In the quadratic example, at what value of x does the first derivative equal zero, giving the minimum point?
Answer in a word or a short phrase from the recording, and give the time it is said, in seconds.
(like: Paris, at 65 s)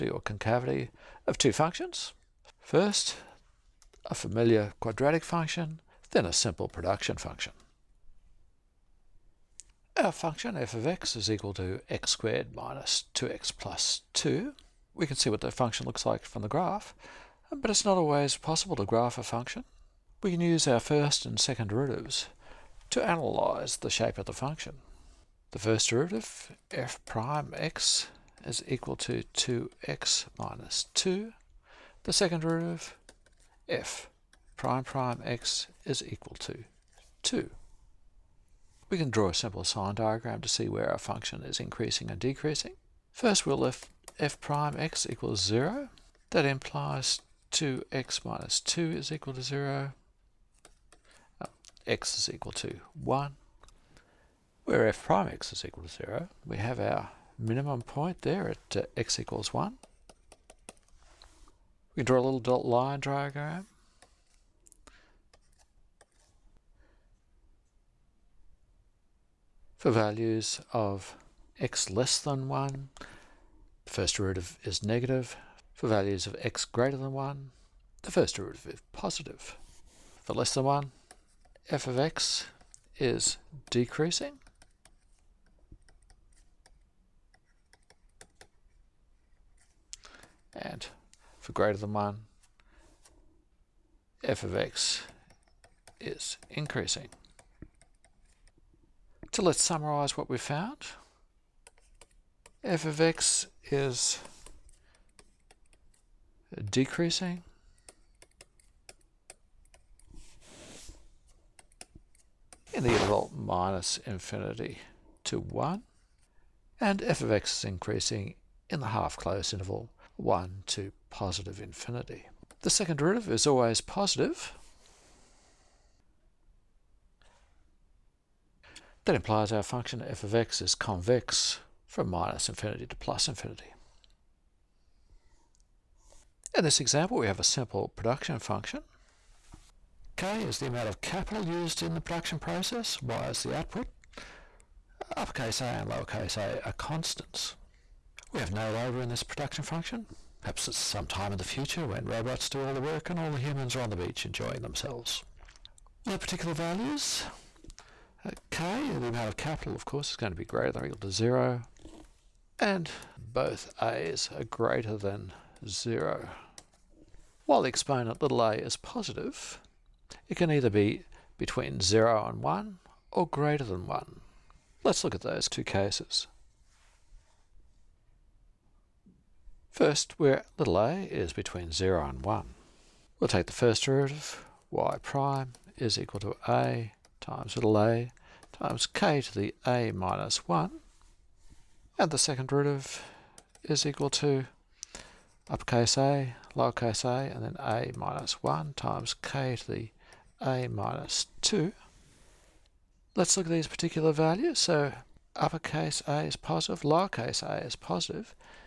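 x = 1, at 51 s.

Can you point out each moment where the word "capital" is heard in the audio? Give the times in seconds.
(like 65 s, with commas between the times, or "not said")
141 s, 159 s.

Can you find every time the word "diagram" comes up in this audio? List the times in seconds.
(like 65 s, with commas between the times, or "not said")
39 s, 63 s.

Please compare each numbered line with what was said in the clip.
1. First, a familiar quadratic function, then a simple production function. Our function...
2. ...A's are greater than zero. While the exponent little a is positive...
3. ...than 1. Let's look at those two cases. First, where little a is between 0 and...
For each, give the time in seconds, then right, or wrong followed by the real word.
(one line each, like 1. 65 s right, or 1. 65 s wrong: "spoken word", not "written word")
1. 2 s right
2. 163 s right
3. 173 s right.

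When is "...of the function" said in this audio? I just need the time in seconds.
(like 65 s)
24 s.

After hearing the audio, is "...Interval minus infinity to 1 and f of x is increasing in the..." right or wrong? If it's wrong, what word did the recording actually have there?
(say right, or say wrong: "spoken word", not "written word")
right.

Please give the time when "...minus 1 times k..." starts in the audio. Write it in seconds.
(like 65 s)
197 s.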